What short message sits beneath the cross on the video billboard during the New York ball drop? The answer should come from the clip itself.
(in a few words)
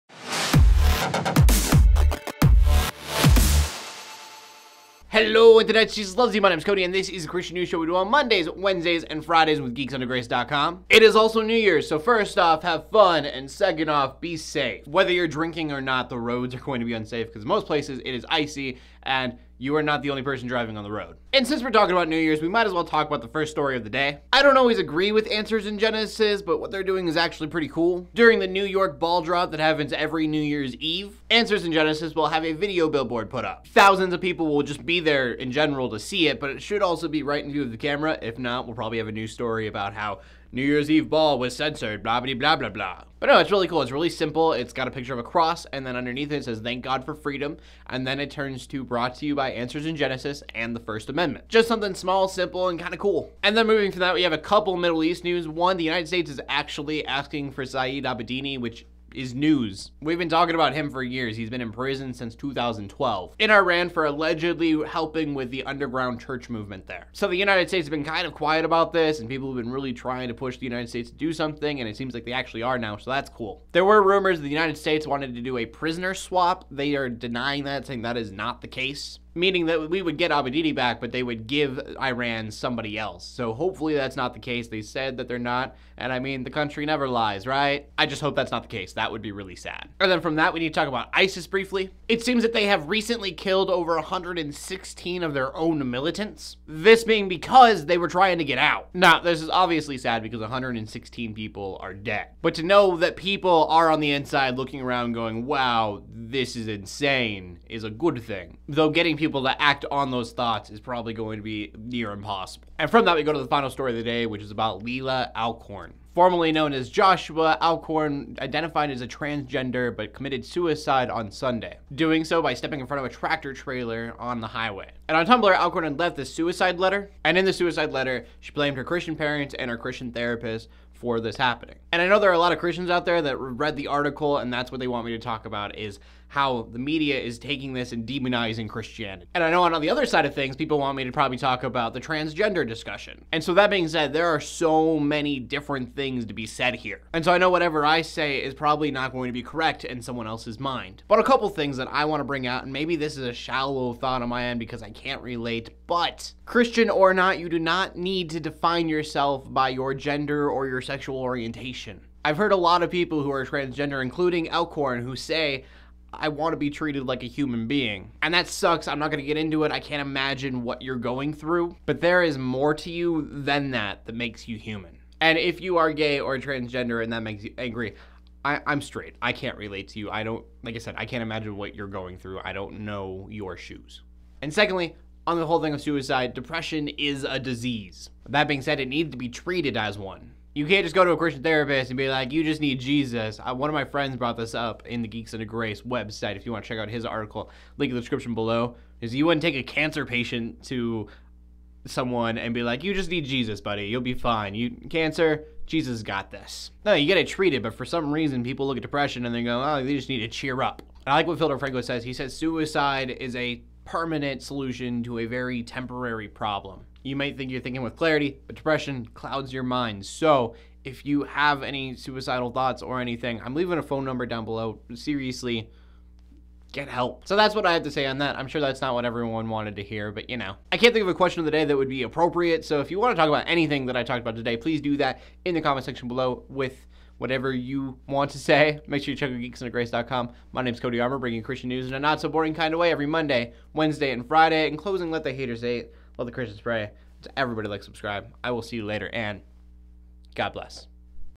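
Thank God for Freedom.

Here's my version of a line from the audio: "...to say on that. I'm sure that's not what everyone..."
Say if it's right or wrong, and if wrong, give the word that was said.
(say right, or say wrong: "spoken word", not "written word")
right.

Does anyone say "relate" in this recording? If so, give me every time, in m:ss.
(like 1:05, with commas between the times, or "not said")
2:35, 2:59.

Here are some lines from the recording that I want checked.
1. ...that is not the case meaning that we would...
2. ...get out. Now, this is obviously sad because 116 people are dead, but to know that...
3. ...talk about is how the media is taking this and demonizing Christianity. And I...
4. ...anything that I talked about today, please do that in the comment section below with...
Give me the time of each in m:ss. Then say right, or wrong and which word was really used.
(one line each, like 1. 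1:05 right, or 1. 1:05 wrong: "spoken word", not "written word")
1. 1:18 right
2. 1:38 right
3. 2:15 right
4. 3:53 right.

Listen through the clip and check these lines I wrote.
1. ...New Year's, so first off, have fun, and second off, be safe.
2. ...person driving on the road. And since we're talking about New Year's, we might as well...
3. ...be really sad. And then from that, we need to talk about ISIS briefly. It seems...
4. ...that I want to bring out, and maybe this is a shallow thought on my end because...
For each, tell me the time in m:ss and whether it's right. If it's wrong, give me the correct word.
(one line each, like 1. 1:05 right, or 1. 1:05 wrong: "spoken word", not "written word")
1. 0:11 right
2. 0:20 right
3. 1:29 right
4. 2:31 right.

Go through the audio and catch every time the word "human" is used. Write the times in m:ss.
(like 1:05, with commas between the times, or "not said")
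2:47, 2:54.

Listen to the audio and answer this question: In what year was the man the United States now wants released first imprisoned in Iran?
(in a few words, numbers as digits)
2012.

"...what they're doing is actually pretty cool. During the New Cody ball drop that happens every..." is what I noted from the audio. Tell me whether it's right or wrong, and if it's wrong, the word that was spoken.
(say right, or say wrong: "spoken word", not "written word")
wrong: "York", not "Cody".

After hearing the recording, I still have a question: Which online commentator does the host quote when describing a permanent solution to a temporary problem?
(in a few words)
Phil DeFranco.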